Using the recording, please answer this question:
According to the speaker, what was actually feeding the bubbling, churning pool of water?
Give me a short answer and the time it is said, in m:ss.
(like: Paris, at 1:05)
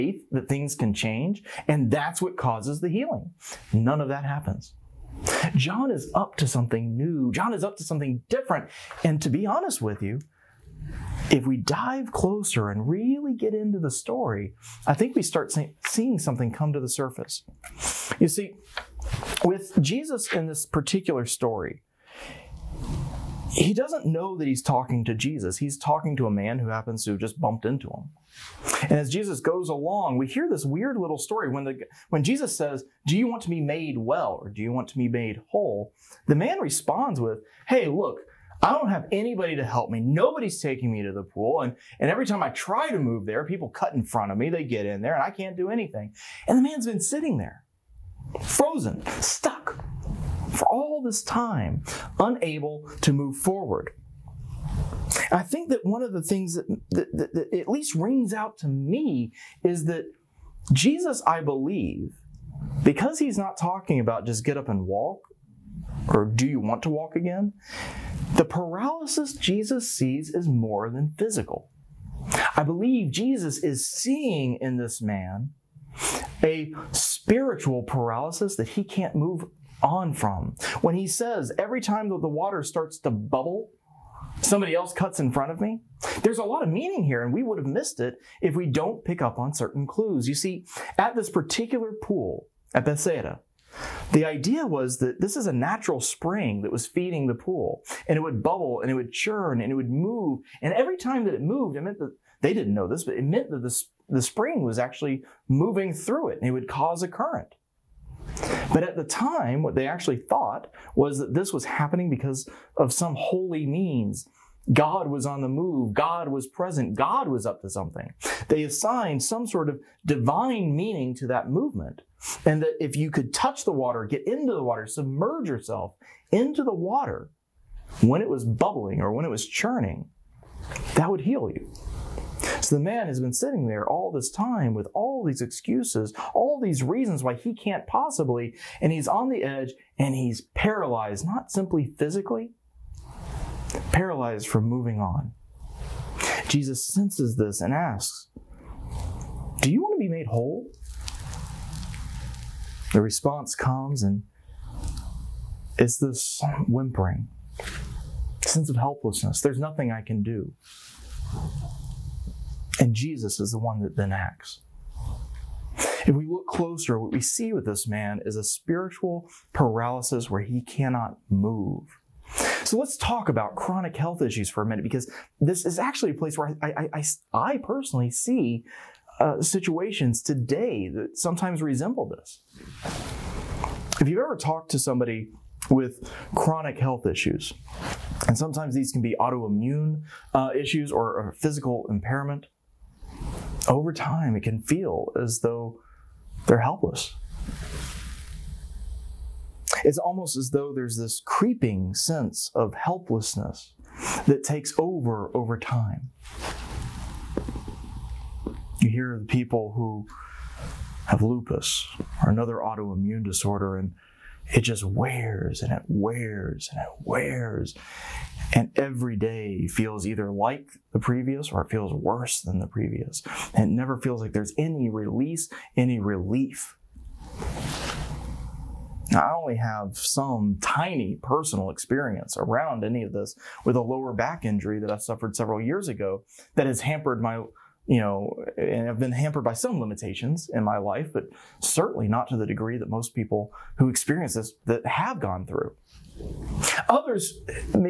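A natural spring, at 1:35.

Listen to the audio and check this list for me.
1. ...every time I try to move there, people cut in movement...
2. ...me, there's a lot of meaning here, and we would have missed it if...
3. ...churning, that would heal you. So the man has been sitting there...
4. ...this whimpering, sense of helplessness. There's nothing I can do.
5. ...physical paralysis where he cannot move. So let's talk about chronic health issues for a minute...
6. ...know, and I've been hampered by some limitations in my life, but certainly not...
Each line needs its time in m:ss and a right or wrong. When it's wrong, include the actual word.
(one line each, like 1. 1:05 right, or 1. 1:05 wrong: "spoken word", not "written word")
1. 0:42 wrong: "front", not "movement"
2. 1:25 right
3. 2:09 right
4. 2:35 right
5. 2:48 wrong: "spiritual", not "physical"
6. 3:57 right.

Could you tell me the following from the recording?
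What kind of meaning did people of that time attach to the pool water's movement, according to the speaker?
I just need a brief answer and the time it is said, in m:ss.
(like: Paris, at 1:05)
Divine meaning, at 2:00.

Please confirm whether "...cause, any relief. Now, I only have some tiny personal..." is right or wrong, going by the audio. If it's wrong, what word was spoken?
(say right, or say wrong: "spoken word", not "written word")
wrong: "release", not "cause".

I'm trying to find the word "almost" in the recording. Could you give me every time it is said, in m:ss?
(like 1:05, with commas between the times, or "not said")
3:19.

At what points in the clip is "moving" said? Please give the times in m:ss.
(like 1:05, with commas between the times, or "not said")
1:45, 2:24.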